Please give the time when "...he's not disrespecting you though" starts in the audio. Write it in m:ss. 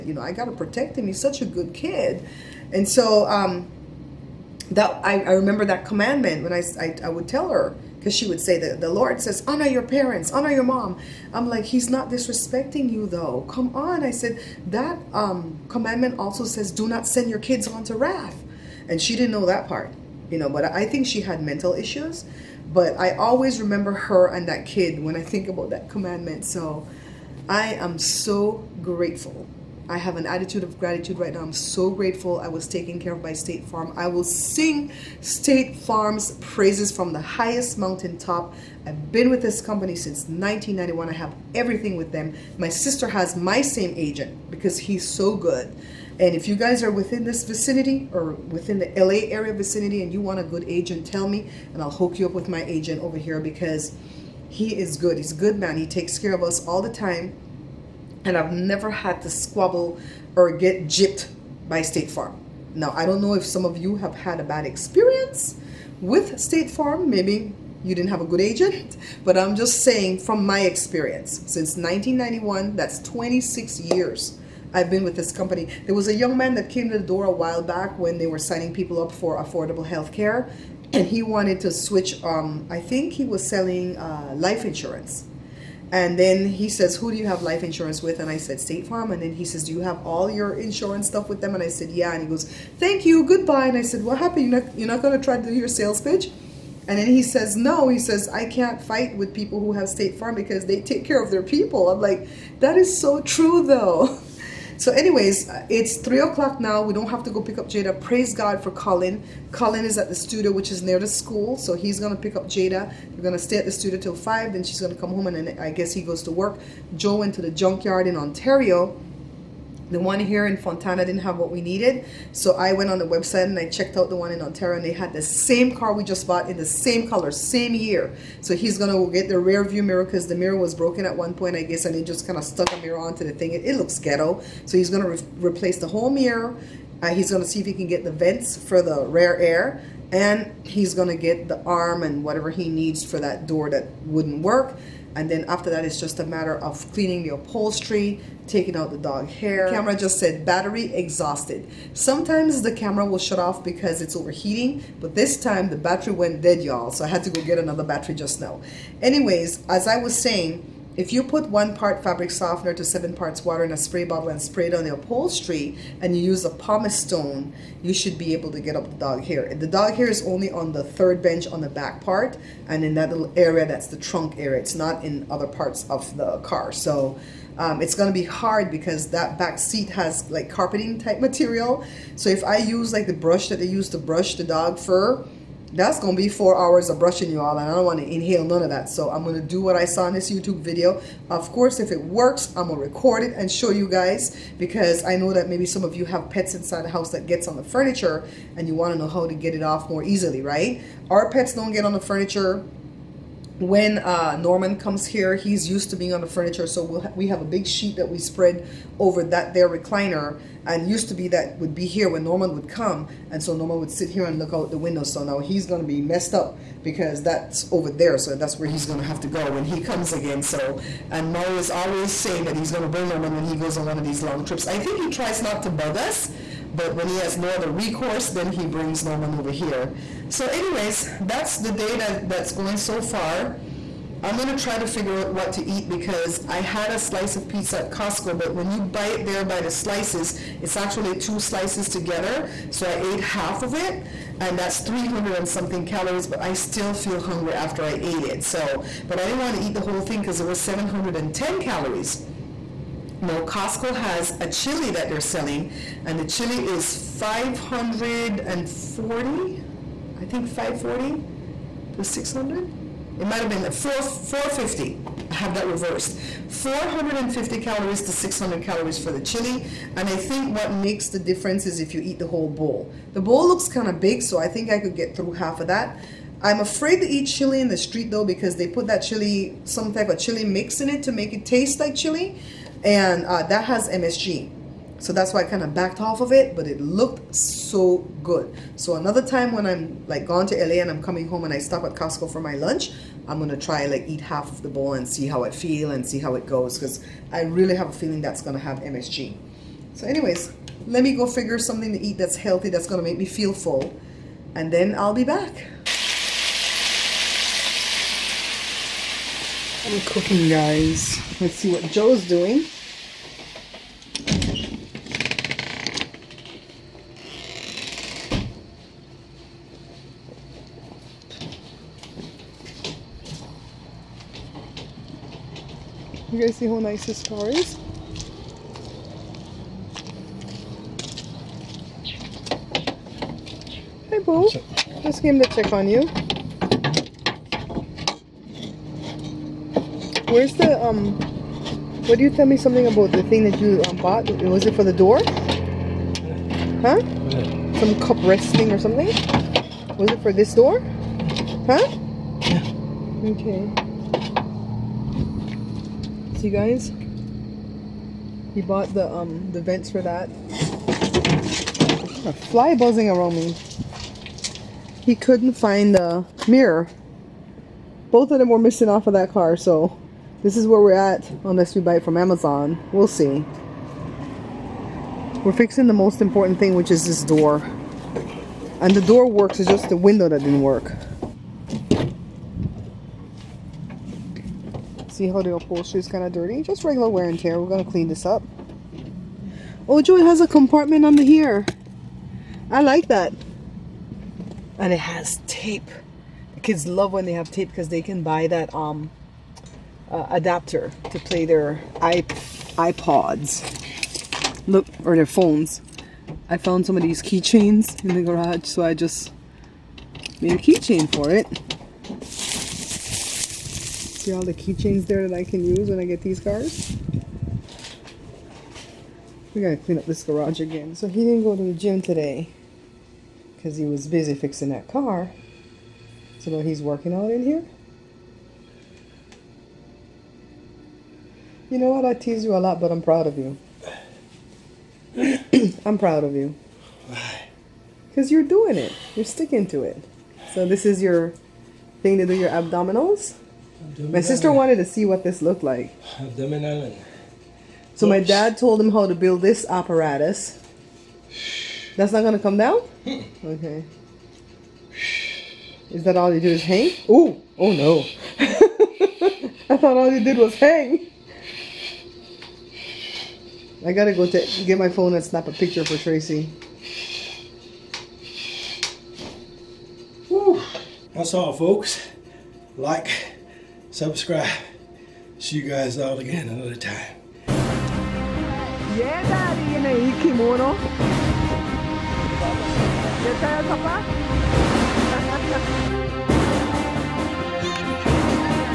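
0:11.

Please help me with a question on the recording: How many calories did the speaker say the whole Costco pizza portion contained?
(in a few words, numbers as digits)
710.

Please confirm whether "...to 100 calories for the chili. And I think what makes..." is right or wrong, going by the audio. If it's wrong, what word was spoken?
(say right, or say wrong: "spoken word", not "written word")
wrong: "600", not "100".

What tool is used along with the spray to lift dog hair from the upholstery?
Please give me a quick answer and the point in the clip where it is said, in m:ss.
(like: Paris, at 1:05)
pumice stone, at 2:46.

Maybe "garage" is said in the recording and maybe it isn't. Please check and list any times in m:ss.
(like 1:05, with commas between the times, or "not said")
6:48, 7:00.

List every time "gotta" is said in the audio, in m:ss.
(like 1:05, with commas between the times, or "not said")
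0:00, 6:59, 7:43.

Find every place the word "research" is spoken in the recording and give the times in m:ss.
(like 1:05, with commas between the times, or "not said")
not said.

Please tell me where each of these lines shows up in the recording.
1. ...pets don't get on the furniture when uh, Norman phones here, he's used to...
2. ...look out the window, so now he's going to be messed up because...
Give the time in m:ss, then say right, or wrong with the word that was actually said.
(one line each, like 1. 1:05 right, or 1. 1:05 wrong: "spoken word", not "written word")
1. 3:21 wrong: "comes", not "phones"
2. 3:34 right.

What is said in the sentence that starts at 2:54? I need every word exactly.
It's not in other parts of the car.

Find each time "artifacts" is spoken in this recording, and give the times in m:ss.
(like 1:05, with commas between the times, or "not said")
not said.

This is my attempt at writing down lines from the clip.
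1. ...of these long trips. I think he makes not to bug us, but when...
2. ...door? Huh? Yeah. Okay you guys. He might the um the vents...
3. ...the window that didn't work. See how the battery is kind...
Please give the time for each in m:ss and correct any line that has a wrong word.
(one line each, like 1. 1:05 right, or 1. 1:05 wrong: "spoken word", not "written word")
1. 3:43 wrong: "tries", not "makes"
2. 5:50 wrong: "bought", not "might"
3. 6:19 wrong: "upholstery", not "battery".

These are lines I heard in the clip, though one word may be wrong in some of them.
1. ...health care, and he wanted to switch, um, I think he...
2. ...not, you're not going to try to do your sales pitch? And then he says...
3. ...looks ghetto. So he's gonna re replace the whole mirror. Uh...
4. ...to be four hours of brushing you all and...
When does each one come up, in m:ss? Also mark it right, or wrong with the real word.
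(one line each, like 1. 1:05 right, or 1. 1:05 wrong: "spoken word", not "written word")
1. 1:19 right
2. 1:34 right
3. 2:13 right
4. 3:06 right.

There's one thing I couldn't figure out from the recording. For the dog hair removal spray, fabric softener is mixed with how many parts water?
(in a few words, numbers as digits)
7.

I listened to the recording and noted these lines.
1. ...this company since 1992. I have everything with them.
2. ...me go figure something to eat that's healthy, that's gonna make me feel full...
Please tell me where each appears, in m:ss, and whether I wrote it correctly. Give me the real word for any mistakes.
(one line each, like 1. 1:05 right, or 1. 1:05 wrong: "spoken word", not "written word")
1. 0:39 wrong: "1991", not "1992"
2. 5:01 right.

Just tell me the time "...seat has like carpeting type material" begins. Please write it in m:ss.
2:59.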